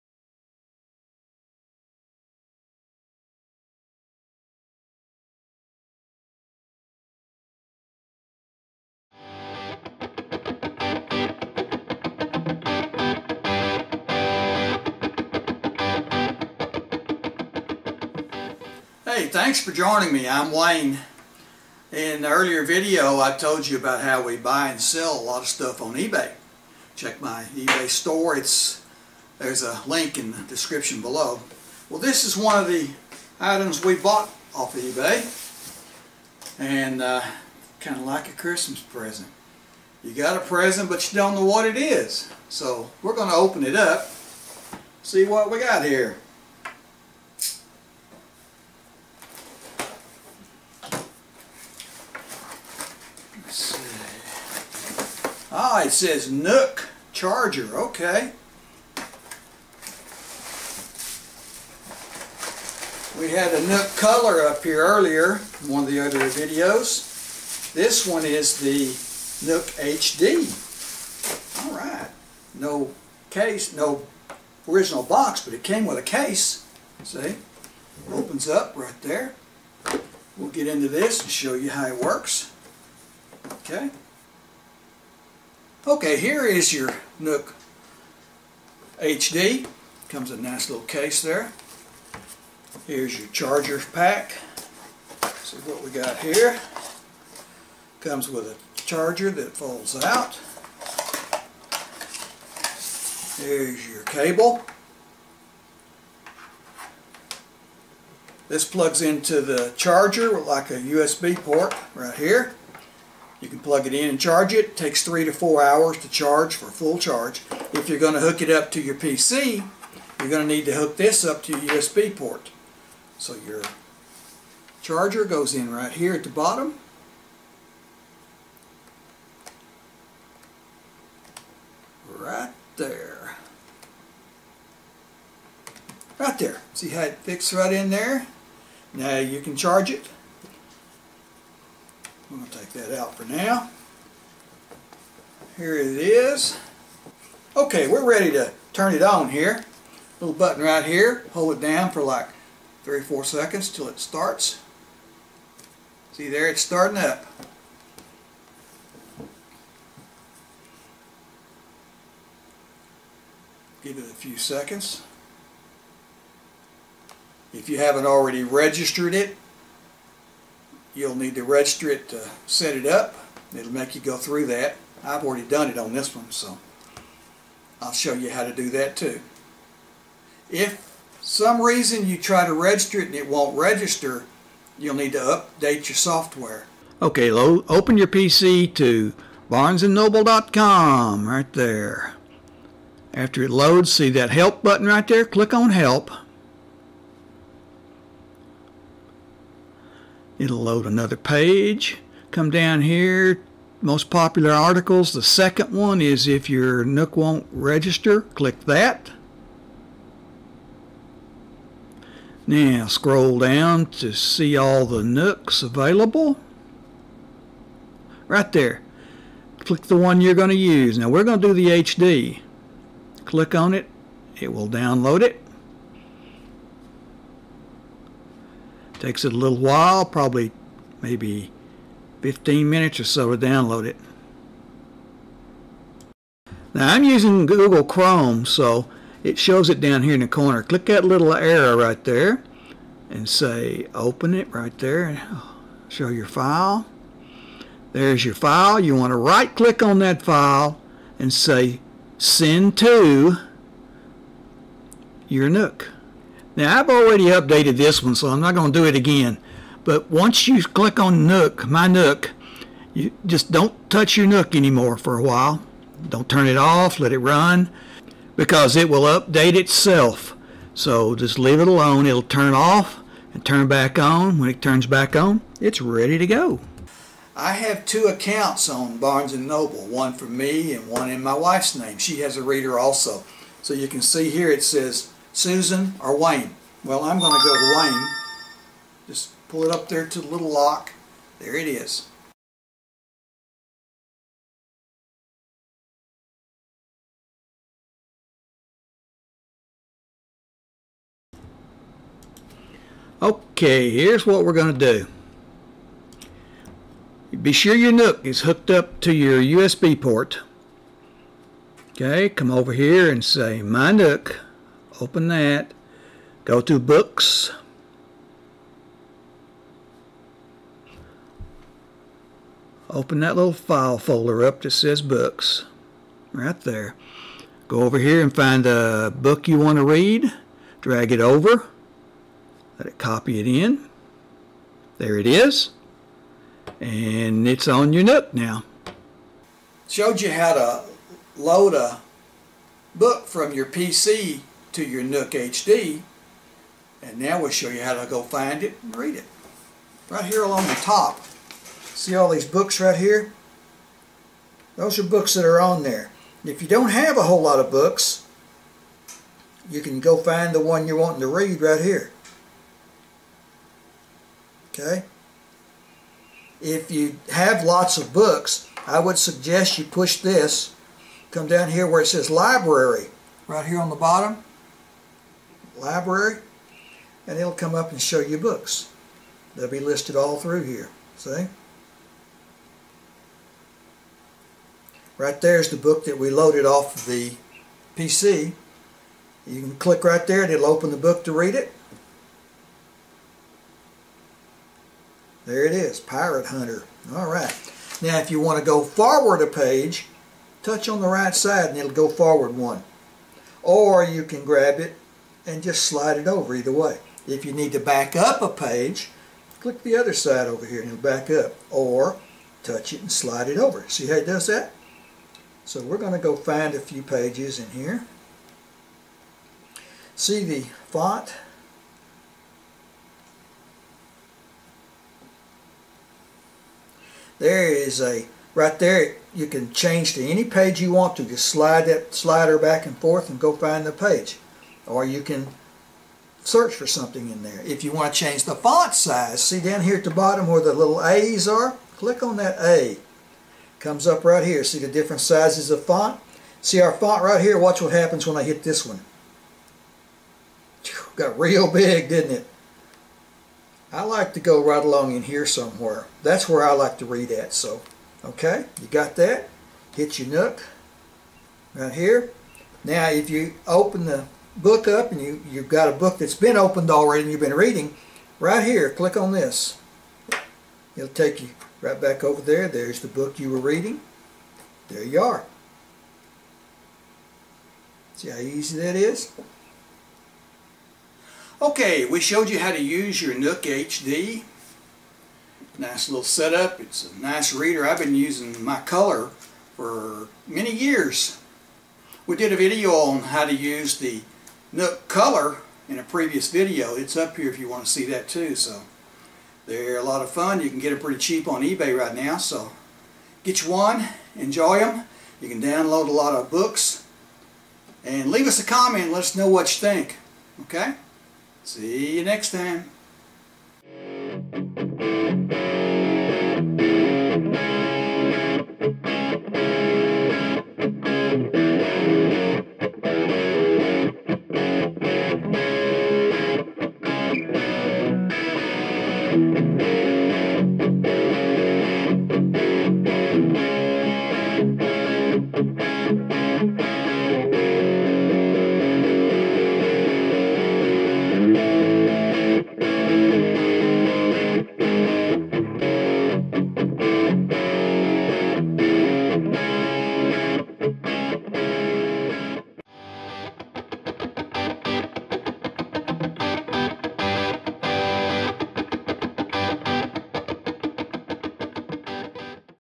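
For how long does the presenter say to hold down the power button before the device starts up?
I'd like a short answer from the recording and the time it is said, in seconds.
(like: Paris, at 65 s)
3 or 4 seconds, at 152 s.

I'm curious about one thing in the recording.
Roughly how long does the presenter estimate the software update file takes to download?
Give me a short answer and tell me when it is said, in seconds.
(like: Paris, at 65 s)
15 minutes, at 232 s.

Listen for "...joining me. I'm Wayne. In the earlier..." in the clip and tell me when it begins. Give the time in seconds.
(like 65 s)
19 s.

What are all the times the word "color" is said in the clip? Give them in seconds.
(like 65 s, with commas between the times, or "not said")
63 s, 488 s, 495 s.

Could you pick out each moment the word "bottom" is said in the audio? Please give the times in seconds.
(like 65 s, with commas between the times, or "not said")
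126 s, 373 s, 440 s.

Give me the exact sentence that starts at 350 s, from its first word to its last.
Right here along the top, see all these books right here?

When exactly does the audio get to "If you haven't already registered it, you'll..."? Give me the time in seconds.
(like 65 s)
167 s.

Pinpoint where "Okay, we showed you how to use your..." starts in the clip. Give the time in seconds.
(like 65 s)
481 s.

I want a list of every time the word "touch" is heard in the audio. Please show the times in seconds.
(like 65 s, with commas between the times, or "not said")
263 s, 400 s, 412 s.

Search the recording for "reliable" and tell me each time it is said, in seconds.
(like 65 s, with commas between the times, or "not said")
not said.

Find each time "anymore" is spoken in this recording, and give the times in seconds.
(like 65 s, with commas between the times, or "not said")
264 s.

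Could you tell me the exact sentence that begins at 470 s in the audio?
It'll take you right back over there.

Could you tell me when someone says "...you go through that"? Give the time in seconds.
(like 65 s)
173 s.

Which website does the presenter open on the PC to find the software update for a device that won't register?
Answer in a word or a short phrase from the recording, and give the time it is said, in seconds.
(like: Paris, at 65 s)
barnesandnoble.com, at 189 s.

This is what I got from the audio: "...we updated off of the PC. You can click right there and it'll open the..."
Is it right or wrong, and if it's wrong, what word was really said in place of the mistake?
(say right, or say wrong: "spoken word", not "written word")
wrong: "loaded", not "updated".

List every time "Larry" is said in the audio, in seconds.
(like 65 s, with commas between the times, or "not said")
not said.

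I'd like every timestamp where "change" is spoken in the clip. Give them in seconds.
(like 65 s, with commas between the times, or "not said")
429 s, 438 s.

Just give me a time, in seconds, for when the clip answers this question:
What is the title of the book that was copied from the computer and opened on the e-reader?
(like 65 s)
395 s.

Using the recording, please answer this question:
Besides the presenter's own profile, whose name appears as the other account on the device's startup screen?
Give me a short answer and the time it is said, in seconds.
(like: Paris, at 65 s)
Susan, at 285 s.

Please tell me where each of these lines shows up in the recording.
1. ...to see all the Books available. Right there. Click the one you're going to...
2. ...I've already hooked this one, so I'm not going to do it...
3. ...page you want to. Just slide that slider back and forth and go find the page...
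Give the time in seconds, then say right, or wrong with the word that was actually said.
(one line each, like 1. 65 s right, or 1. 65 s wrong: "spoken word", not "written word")
1. 213 s wrong: "Nooks", not "Books"
2. 256 s wrong: "updated", not "hooked"
3. 430 s right.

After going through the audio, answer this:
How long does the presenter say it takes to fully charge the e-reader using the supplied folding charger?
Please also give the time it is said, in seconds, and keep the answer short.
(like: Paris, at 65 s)
3 to 4 hours, at 115 s.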